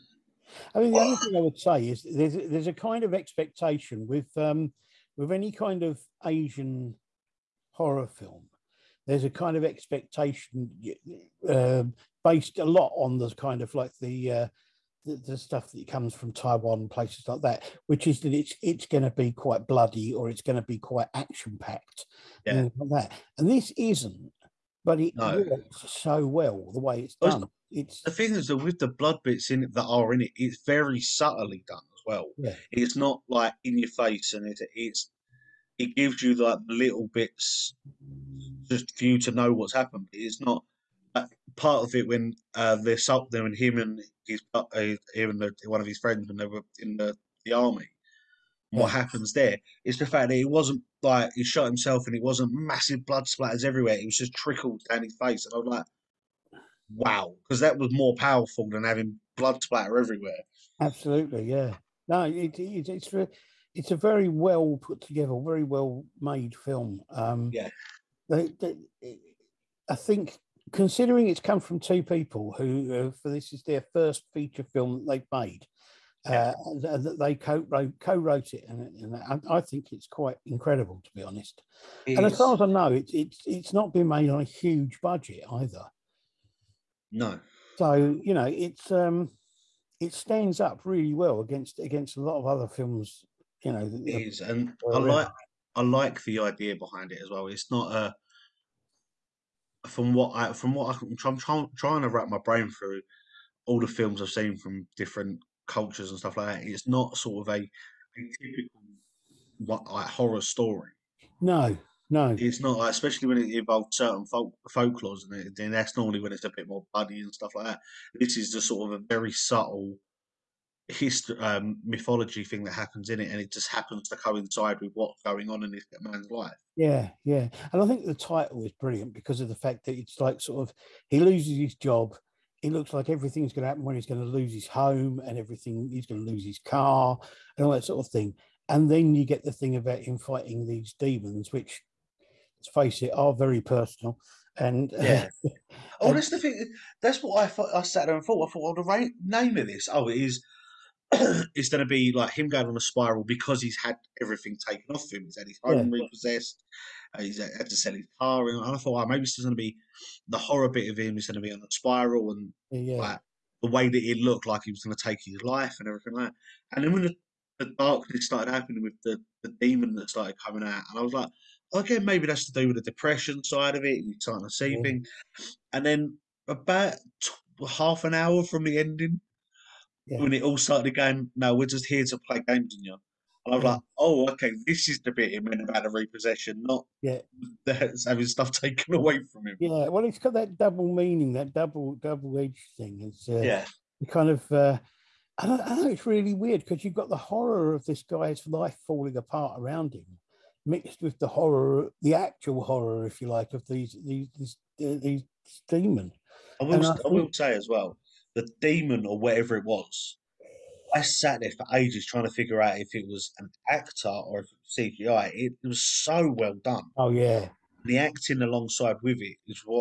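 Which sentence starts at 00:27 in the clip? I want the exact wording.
it's the thing is that with the blood bits in it that are in it, it's very subtly done as well.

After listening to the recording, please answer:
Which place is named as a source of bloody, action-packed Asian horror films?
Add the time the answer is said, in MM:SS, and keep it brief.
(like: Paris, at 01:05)
Taiwan, at 00:16.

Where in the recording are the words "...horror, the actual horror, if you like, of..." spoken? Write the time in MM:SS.
03:21.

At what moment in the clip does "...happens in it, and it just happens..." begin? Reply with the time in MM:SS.
02:02.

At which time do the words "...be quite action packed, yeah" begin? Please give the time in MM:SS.
00:20.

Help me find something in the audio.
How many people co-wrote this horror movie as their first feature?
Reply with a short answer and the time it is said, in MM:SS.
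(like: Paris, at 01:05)
2, at 01:11.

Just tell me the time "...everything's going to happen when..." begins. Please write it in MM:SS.
02:13.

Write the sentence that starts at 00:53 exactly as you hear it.
It was just trickled down his face, and I was like, "Wow!" Because that was more powerful than having blood splatter everywhere.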